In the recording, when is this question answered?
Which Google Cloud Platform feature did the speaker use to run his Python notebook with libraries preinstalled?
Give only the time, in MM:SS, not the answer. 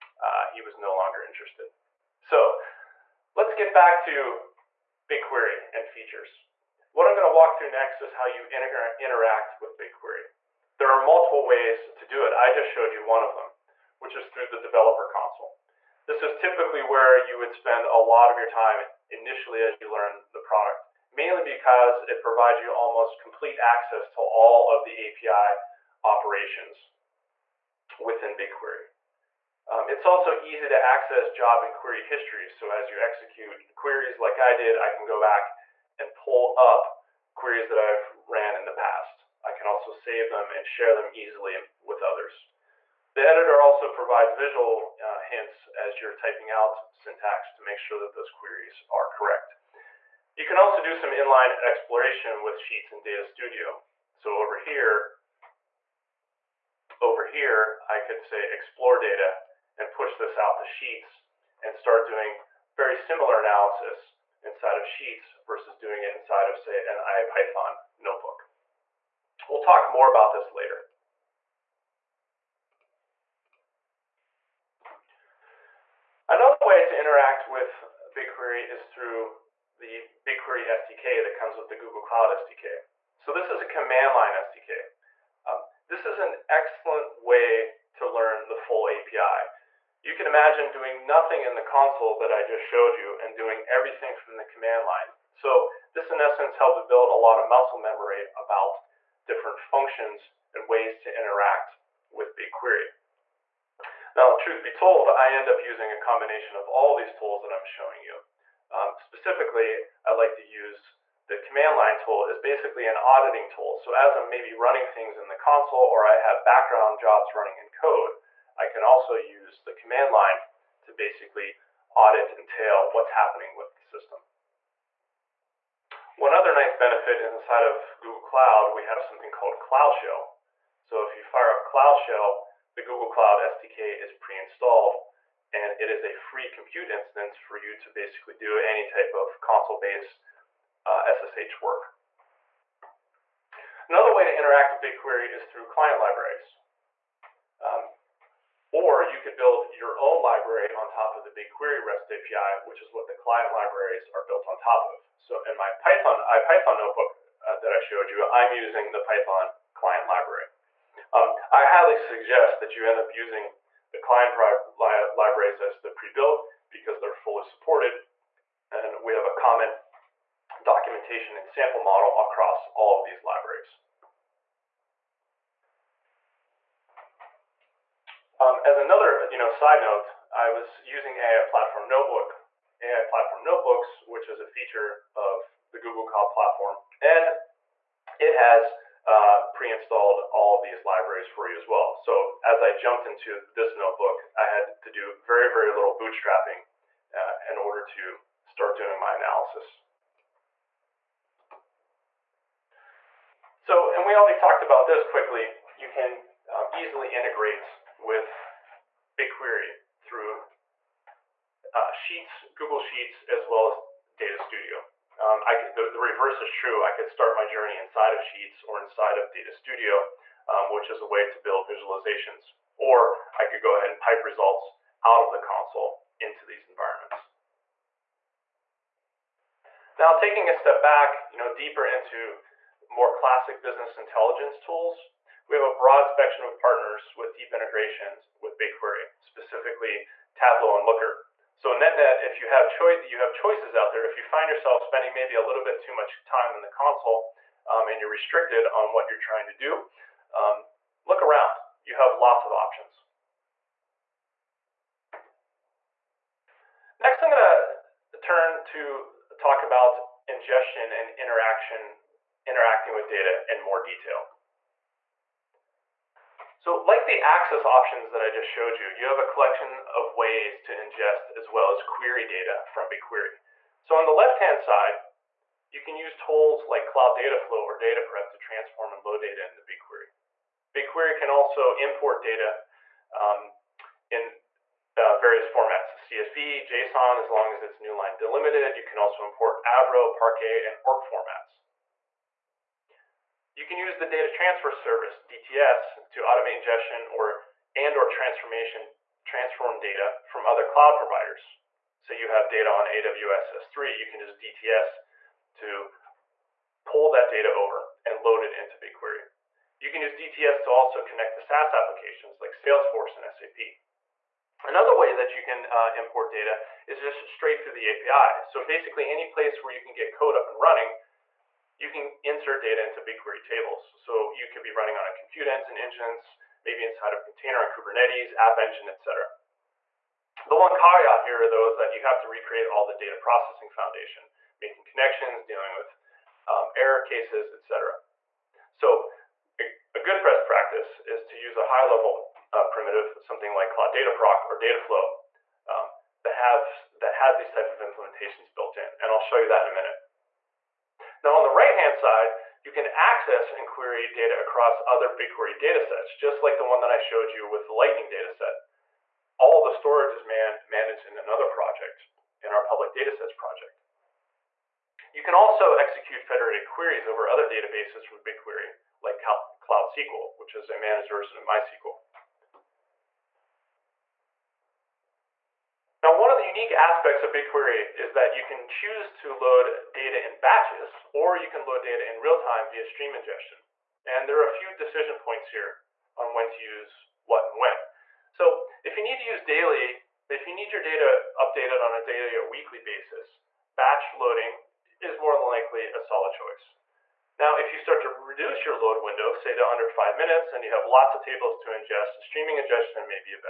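03:02.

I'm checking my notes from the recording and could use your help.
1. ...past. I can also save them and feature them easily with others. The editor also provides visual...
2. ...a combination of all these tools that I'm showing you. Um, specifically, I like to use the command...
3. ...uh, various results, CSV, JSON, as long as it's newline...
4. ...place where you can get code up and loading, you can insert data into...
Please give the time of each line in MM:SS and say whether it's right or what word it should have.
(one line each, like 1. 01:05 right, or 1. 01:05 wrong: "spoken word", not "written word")
1. 00:38 wrong: "share", not "feature"
2. 01:45 right
3. 04:44 wrong: "formats", not "results"
4. 05:19 wrong: "running", not "loading".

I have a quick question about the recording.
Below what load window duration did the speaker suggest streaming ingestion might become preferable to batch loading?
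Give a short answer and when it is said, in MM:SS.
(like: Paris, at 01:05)
5 minutes, at 06:39.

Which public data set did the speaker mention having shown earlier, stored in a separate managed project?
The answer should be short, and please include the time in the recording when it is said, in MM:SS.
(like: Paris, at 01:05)
Lightning, at 05:57.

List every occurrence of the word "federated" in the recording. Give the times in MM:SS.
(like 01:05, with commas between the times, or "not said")
06:06.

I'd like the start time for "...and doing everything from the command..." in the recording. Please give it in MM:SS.
01:33.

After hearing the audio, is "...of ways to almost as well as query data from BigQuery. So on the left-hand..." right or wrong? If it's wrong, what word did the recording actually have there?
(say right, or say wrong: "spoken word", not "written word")
wrong: "ingest", not "almost".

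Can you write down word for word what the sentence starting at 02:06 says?
One other nice benefit is inside of Google Cloud, we have something called Cloud Shell.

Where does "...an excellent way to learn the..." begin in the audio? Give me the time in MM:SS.
01:26.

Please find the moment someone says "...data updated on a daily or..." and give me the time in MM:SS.
06:30.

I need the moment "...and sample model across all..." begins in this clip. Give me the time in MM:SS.
02:51.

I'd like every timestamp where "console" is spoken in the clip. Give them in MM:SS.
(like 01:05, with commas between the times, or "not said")
00:15, 01:31, 01:55, 02:19, 03:45, 04:06.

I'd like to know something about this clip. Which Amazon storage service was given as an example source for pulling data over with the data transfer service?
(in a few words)
AWS S3.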